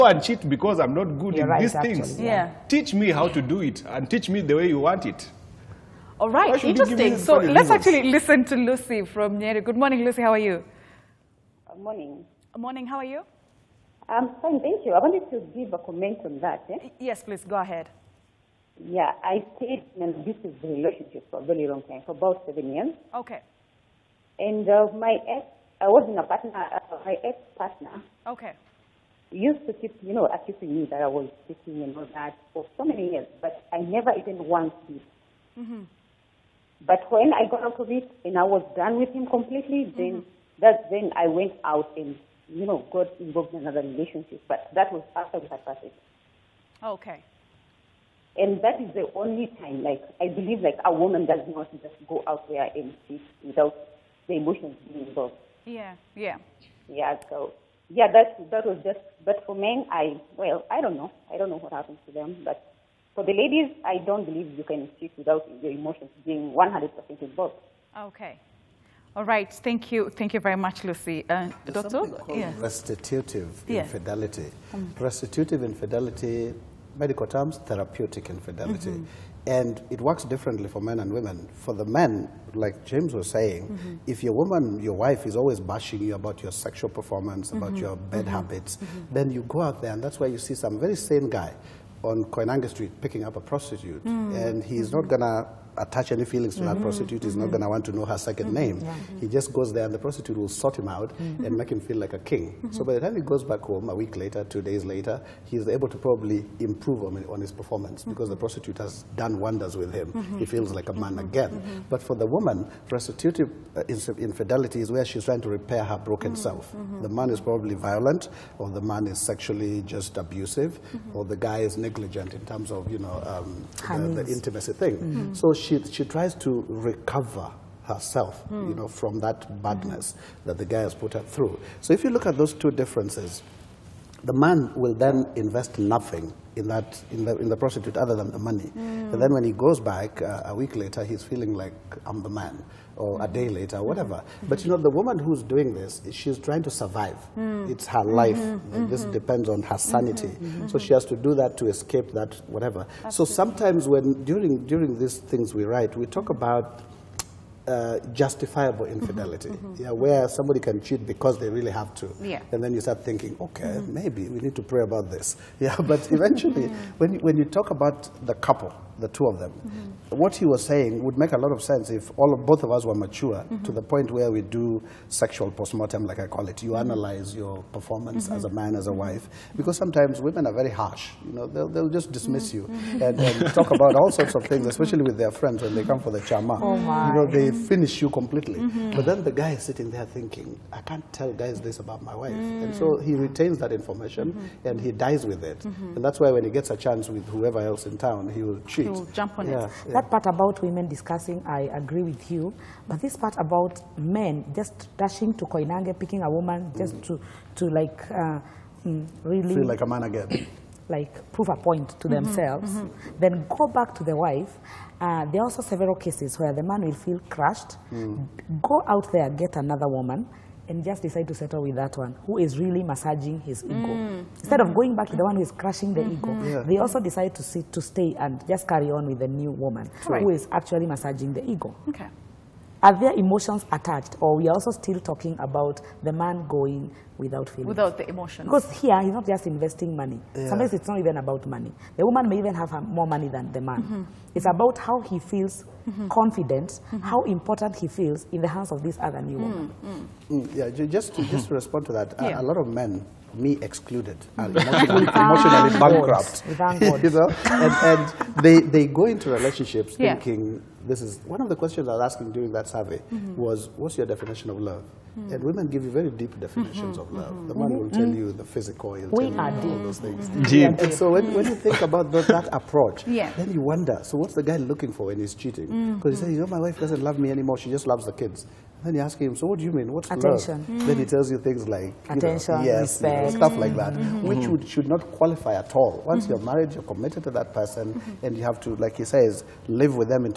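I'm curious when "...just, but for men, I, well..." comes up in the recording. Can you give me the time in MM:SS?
00:58.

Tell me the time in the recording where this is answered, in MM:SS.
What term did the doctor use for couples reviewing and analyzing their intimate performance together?
02:55.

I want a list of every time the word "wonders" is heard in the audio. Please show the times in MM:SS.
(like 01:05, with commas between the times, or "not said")
01:49, 04:33.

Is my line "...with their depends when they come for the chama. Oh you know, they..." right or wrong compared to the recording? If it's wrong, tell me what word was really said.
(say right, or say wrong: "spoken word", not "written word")
wrong: "friends", not "depends".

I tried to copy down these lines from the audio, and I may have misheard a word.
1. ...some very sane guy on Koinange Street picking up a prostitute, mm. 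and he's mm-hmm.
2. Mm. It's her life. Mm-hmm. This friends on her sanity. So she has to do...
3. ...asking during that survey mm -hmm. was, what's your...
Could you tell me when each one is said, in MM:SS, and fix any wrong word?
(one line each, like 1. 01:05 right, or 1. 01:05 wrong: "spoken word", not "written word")
1. 01:30 right
2. 02:27 wrong: "depends", not "friends"
3. 04:22 right.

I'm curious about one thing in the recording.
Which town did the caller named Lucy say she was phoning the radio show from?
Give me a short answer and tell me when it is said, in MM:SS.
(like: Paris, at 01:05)
Nyeri, at 00:09.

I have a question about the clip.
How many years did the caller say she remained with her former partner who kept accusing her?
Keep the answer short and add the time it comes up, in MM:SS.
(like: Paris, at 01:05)
7, at 00:22.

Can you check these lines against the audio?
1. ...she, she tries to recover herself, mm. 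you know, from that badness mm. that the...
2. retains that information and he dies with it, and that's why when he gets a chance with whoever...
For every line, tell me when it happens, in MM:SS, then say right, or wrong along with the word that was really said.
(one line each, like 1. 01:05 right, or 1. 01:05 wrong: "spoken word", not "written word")
1. 02:05 right
2. 03:13 right.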